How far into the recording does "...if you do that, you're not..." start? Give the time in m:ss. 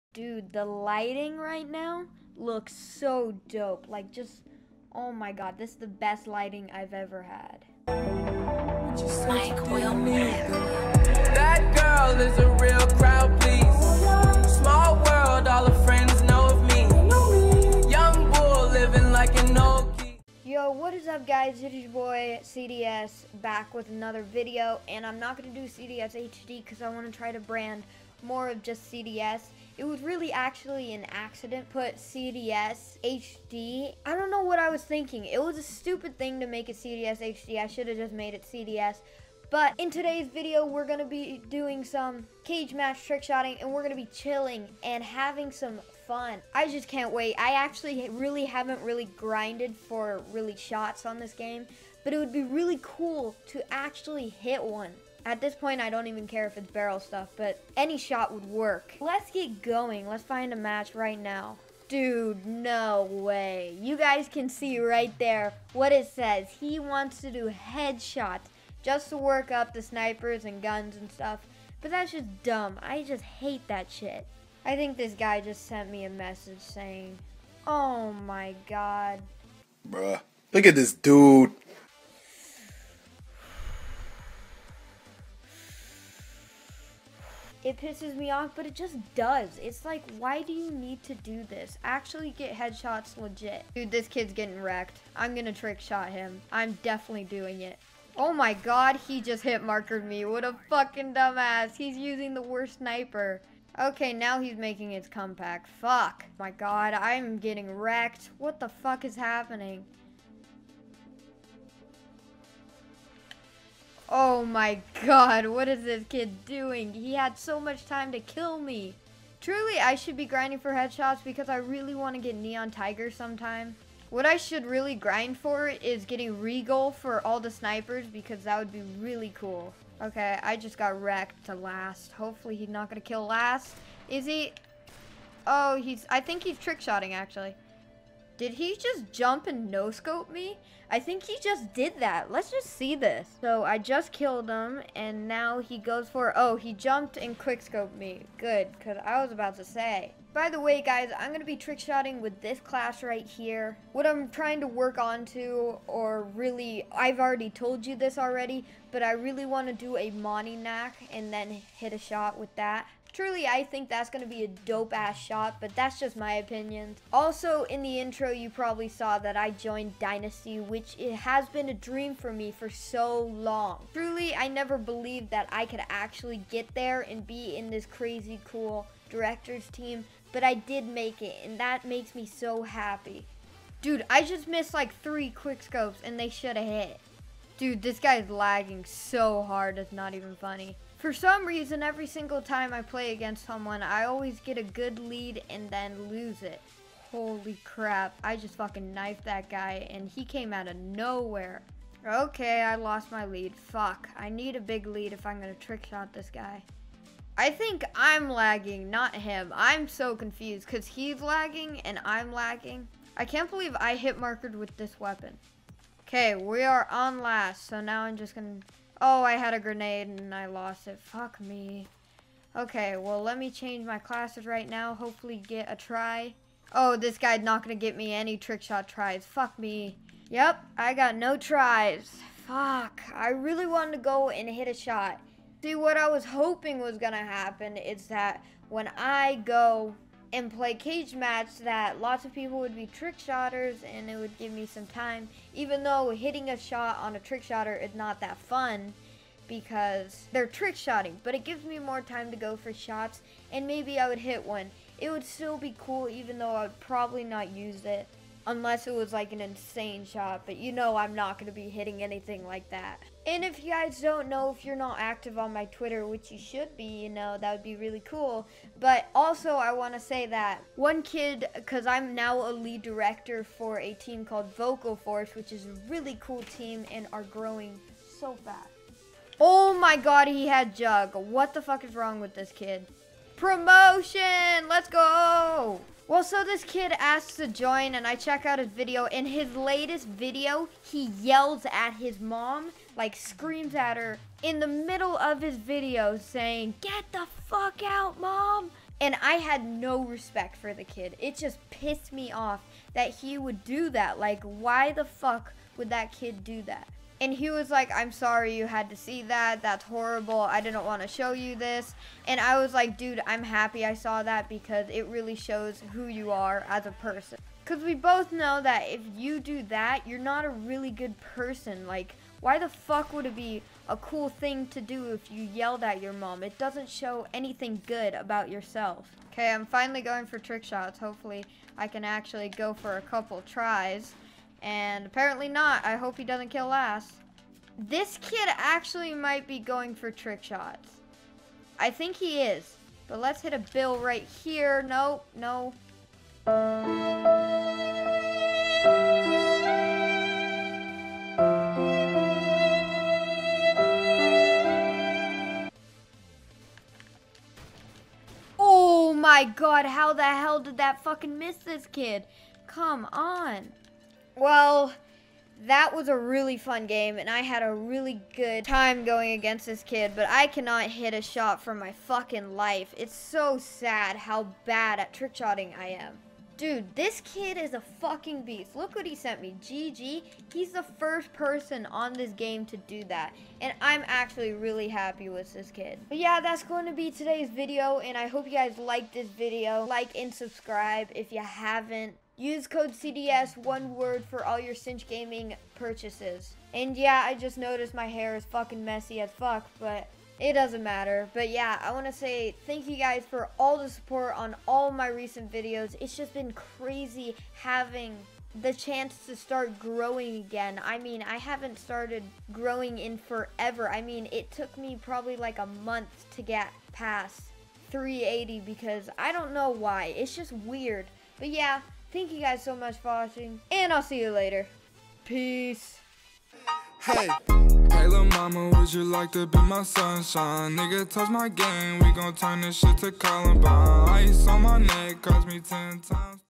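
5:18.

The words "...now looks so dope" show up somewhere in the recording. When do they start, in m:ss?
0:01.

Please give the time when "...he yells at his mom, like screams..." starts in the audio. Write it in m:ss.
4:50.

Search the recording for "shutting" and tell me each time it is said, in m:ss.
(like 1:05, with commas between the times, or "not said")
not said.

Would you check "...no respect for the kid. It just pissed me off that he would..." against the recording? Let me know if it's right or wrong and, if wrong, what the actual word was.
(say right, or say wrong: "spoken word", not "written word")
right.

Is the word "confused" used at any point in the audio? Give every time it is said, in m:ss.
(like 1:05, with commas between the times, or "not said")
3:30.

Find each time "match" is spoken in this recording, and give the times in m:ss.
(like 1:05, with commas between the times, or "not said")
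0:42, 1:00, 4:01.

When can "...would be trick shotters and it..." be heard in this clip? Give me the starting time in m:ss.
4:02.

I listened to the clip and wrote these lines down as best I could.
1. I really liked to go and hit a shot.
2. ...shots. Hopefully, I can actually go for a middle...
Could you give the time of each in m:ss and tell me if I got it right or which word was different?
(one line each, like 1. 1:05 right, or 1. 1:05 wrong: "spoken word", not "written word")
1. 3:53 wrong: "wanted", not "liked"
2. 5:30 wrong: "couple", not "middle".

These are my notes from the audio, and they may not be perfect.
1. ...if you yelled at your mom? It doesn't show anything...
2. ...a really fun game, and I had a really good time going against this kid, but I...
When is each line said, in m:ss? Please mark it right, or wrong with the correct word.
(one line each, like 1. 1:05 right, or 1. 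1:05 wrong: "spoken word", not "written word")
1. 5:25 right
2. 6:06 right.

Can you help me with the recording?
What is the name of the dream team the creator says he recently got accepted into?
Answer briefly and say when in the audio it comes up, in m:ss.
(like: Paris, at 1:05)
Dynasty, at 2:49.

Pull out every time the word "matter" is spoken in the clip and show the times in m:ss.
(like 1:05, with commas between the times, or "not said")
6:40.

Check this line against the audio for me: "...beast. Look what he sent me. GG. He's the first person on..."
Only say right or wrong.
right.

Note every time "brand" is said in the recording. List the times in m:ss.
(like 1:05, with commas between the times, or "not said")
0:27.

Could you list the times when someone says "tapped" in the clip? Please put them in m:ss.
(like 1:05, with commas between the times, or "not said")
not said.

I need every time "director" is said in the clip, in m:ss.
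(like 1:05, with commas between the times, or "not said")
2:59, 4:32.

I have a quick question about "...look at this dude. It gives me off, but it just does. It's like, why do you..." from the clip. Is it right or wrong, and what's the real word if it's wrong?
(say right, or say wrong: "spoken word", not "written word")
wrong: "pisses", not "gives".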